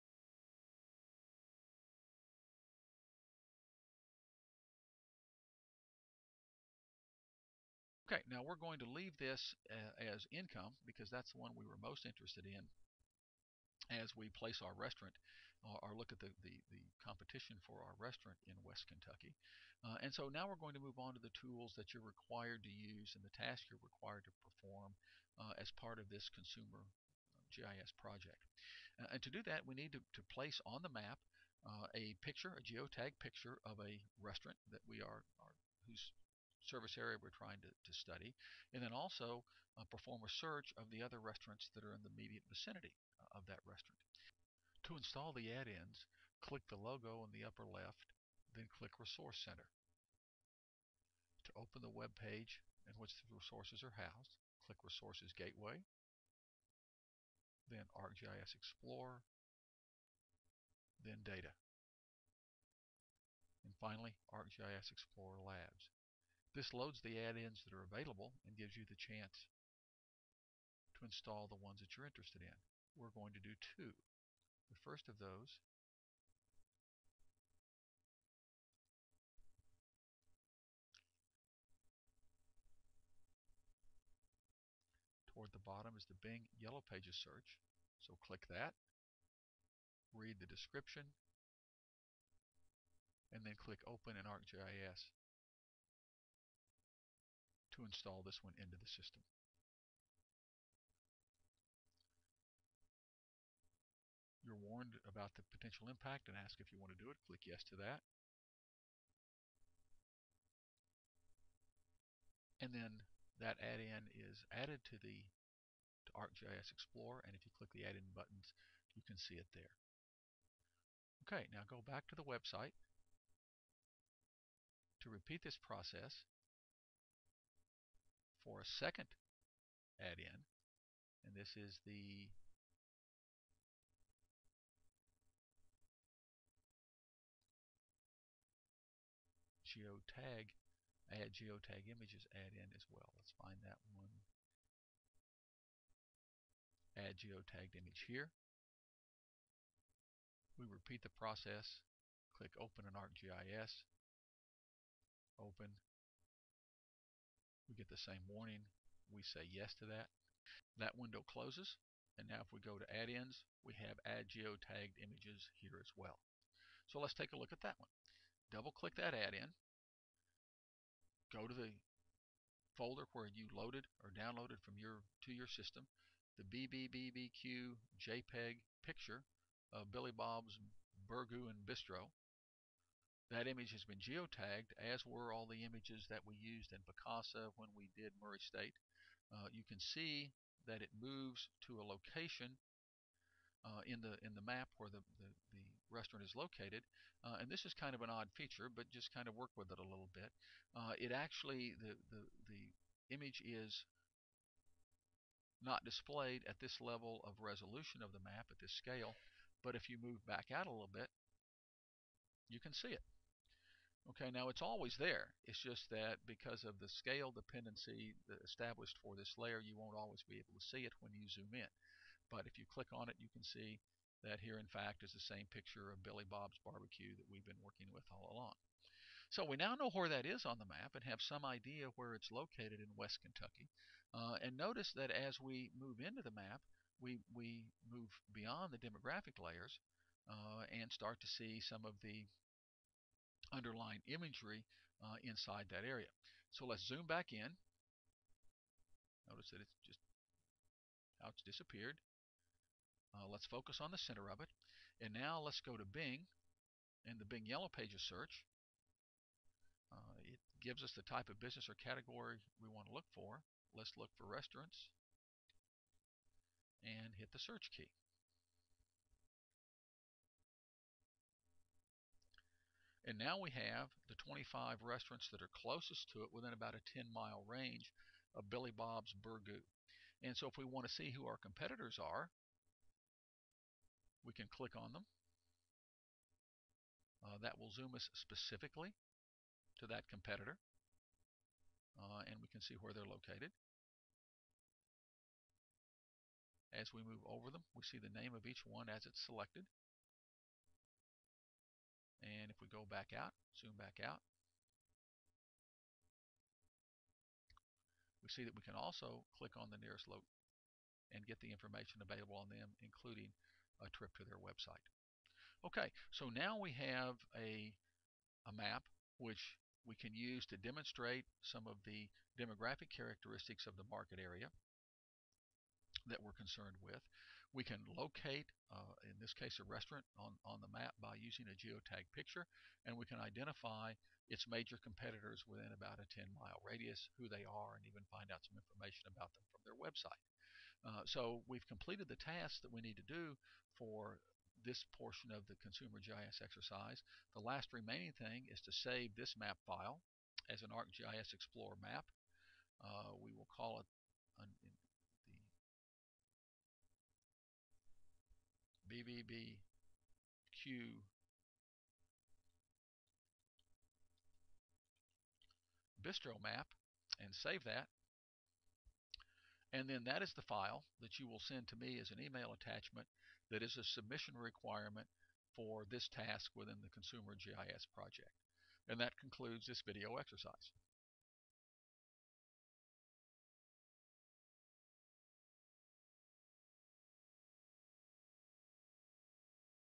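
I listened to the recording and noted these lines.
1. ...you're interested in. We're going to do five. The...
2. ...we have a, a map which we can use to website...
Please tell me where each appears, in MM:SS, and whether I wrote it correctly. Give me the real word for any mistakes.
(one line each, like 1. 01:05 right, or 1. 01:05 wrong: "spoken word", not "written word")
1. 01:11 wrong: "two", not "five"
2. 05:16 wrong: "demonstrate", not "website".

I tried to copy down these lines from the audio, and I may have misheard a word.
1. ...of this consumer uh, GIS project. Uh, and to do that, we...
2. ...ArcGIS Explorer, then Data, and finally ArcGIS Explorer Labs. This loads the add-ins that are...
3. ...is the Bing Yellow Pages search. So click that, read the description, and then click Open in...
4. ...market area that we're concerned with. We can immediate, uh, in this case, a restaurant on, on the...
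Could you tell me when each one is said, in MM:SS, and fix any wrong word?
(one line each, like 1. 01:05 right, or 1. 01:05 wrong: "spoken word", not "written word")
1. 00:25 right
2. 00:57 right
3. 01:25 right
4. 05:23 wrong: "locate", not "immediate".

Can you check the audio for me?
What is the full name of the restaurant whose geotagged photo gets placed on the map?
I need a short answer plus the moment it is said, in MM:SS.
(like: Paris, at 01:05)
Billy Bob's Burgoo and Bistro, at 02:59.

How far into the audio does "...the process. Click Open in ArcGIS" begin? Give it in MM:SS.
02:31.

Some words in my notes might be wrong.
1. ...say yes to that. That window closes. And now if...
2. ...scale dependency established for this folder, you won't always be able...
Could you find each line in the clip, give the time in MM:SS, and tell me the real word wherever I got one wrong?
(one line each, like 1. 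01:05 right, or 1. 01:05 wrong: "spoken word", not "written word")
1. 02:39 right
2. 03:36 wrong: "layer", not "folder".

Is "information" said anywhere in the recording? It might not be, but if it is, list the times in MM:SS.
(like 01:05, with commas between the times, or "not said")
05:11, 05:38.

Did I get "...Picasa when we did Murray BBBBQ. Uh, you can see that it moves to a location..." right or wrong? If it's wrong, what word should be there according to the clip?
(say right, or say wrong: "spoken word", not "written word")
wrong: "State", not "BBBBQ".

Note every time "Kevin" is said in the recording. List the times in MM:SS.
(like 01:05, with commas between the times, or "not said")
not said.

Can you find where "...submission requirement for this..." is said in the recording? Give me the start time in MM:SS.
06:13.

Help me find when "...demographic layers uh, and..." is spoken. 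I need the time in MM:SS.
03:58.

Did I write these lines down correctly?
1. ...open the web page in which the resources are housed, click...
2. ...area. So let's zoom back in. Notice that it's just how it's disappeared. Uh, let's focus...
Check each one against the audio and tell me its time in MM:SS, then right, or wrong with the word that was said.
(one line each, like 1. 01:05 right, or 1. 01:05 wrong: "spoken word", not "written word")
1. 00:51 right
2. 04:05 right.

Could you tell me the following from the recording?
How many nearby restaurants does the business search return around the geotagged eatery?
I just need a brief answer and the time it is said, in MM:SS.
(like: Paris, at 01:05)
25, at 04:34.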